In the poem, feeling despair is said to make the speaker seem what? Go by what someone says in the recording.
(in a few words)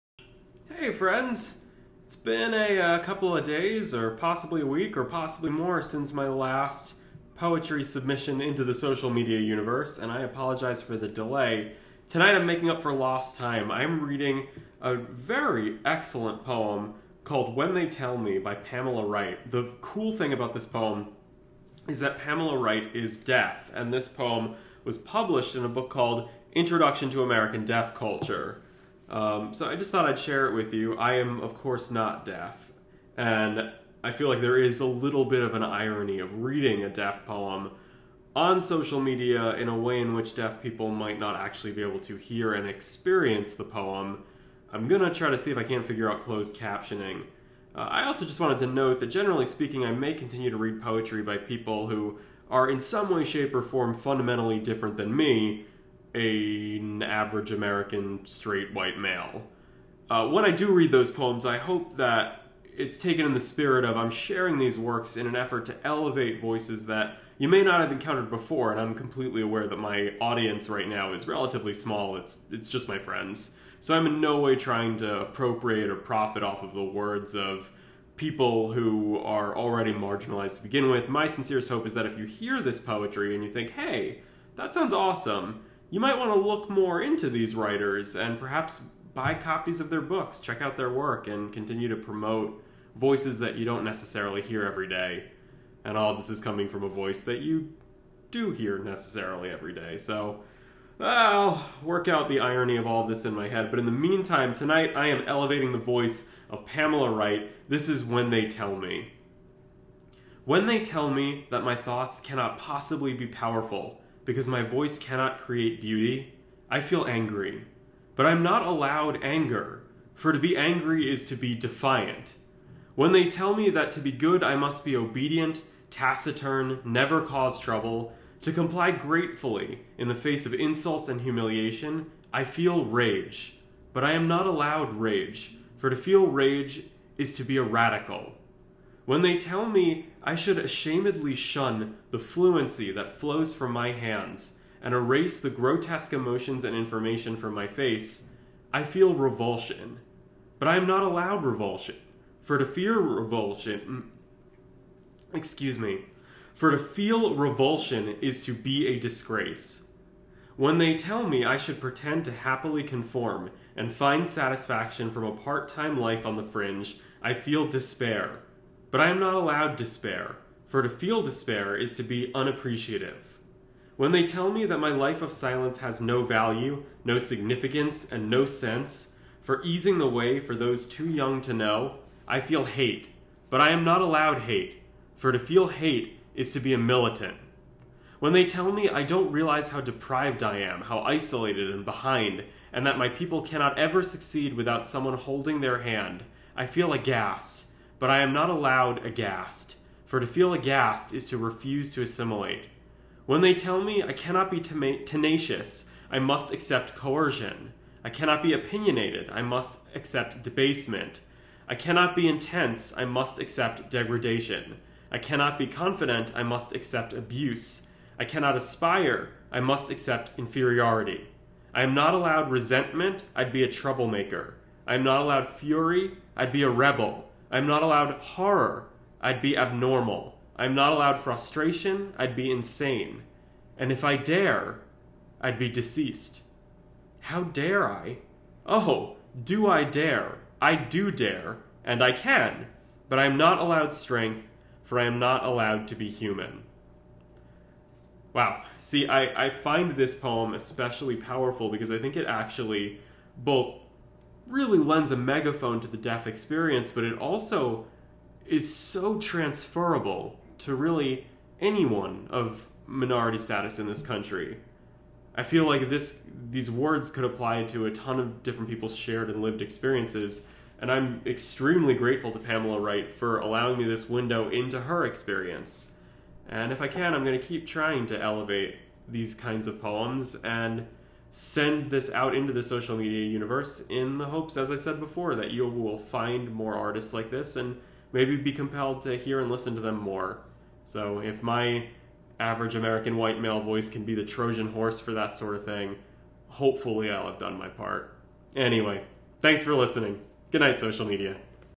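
unappreciative.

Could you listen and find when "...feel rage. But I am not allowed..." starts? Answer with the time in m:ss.
2:12.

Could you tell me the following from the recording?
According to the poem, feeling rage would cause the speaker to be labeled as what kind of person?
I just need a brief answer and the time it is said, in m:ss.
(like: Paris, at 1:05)
a radical, at 2:17.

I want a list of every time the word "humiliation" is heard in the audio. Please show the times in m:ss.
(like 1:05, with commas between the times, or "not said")
2:11.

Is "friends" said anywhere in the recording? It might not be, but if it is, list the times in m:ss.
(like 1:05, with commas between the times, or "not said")
0:00, 1:12.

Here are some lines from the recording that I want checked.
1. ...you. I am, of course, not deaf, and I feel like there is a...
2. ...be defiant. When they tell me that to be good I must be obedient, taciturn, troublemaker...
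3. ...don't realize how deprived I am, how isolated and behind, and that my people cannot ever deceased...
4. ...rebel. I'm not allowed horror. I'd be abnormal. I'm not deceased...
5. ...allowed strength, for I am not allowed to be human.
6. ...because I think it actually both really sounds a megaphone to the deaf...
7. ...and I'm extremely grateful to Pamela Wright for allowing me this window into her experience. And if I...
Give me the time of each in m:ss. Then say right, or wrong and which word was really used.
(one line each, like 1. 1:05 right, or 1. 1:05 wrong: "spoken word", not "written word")
1. 0:30 right
2. 2:01 wrong: "never", not "troublemaker"
3. 3:09 wrong: "succeed", not "deceased"
4. 3:46 wrong: "allowed", not "deceased"
5. 4:03 right
6. 4:11 wrong: "lends", not "sounds"
7. 4:30 right.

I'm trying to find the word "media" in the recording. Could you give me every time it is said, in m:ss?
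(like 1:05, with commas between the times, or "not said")
0:09, 0:39, 4:42, 5:01.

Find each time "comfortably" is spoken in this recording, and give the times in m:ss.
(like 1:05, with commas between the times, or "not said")
not said.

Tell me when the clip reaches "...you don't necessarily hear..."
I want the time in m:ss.
1:33.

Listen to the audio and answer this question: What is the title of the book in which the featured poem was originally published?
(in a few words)
Introduction to American Deaf Culture.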